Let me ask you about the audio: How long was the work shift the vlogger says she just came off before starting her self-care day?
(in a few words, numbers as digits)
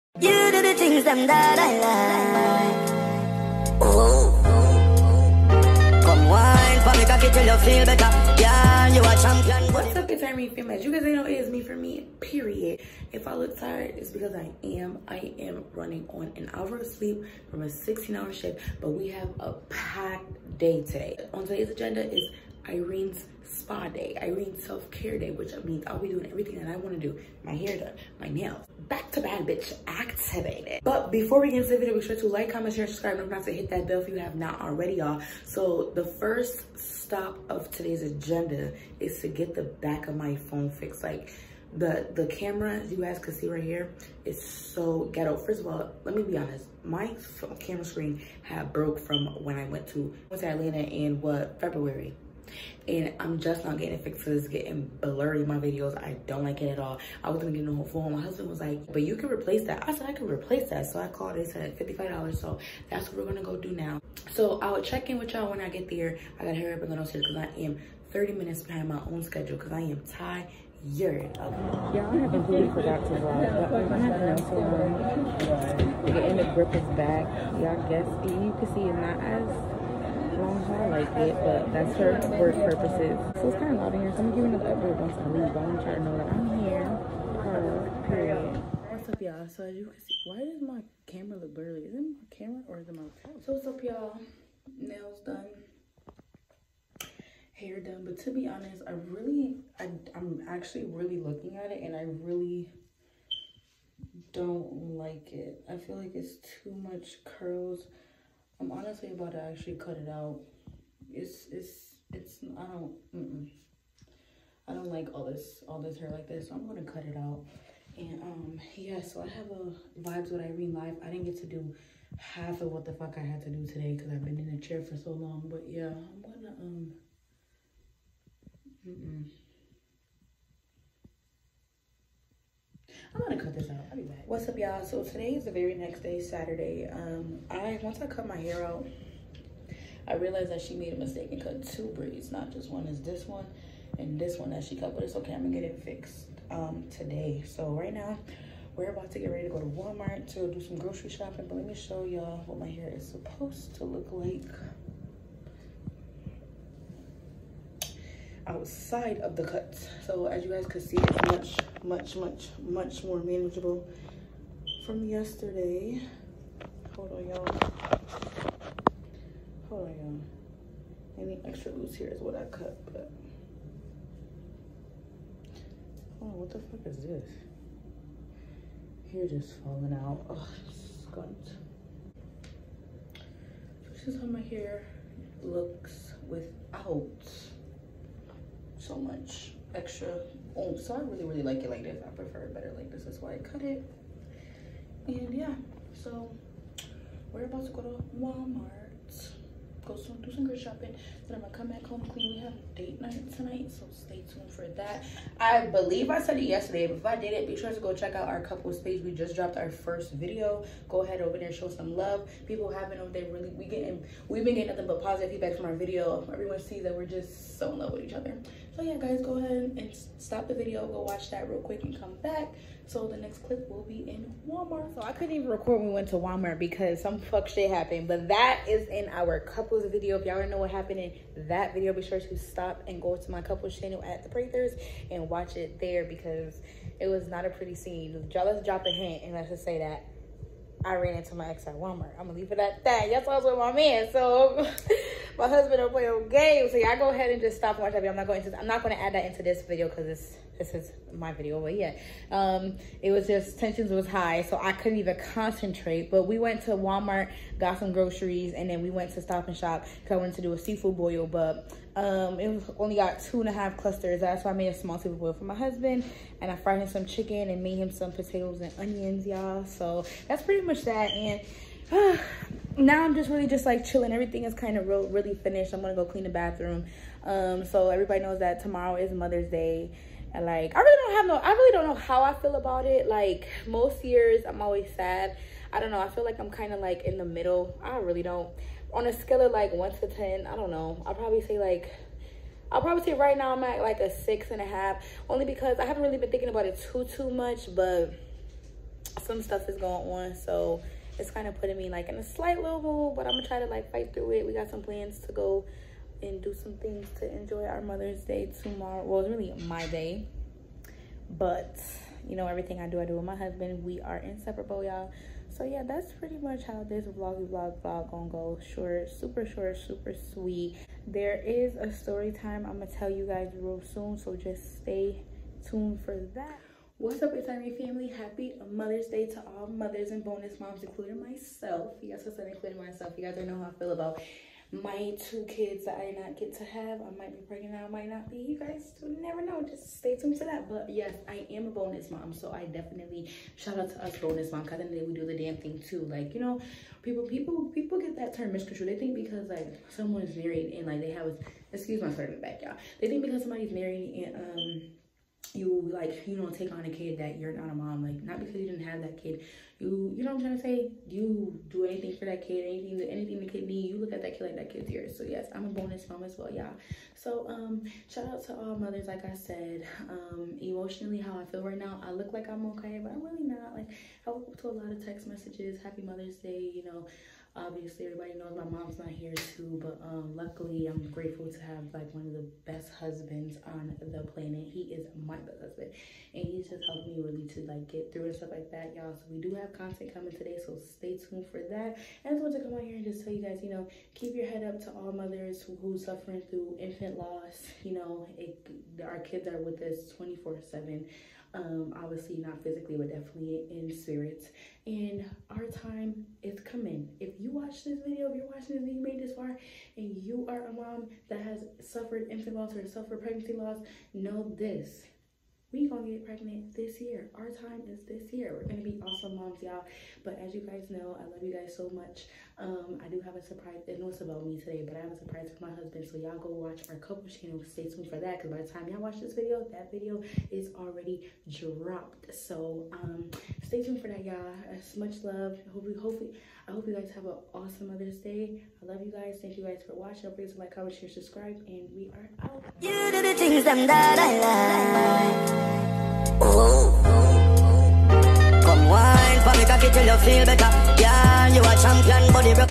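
16 hours.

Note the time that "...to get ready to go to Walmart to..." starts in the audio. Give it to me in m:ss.
2:29.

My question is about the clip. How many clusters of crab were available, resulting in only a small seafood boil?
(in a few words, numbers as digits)
2.5.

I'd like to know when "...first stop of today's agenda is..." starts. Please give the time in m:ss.
0:36.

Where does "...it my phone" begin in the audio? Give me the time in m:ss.
1:32.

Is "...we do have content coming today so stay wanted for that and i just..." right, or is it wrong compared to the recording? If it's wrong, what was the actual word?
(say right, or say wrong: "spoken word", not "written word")
wrong: "tuned", not "wanted".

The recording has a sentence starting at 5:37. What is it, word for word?
I might be pregnant I might not be.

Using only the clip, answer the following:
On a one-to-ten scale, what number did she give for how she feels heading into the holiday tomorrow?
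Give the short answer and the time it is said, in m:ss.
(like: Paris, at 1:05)
6.5, at 4:54.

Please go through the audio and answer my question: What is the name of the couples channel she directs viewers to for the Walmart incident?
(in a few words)
The Prathers.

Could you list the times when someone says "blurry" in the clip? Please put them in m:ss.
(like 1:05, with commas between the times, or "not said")
0:55, 1:31.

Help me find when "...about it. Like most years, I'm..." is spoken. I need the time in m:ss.
4:42.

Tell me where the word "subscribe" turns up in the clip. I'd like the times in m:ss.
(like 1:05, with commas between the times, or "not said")
0:32, 7:21.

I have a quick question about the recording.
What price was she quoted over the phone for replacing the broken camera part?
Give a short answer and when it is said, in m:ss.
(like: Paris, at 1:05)
$55, at 1:01.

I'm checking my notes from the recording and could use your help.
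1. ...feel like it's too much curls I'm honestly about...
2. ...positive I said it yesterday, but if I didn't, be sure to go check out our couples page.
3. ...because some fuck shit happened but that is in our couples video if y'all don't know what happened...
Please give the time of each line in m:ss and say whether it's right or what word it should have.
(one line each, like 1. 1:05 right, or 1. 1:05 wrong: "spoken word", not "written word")
1. 1:45 right
2. 3:25 wrong: "believe", not "positive"
3. 3:46 right.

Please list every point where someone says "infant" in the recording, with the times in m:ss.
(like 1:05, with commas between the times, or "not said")
6:36, 6:52.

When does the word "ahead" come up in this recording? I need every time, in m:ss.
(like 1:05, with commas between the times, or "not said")
3:31, 3:39, 4:07.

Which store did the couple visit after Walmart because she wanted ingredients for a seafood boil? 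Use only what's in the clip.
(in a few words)
Stop and Shop.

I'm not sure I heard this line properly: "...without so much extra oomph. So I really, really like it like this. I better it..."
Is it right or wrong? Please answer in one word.
wrong.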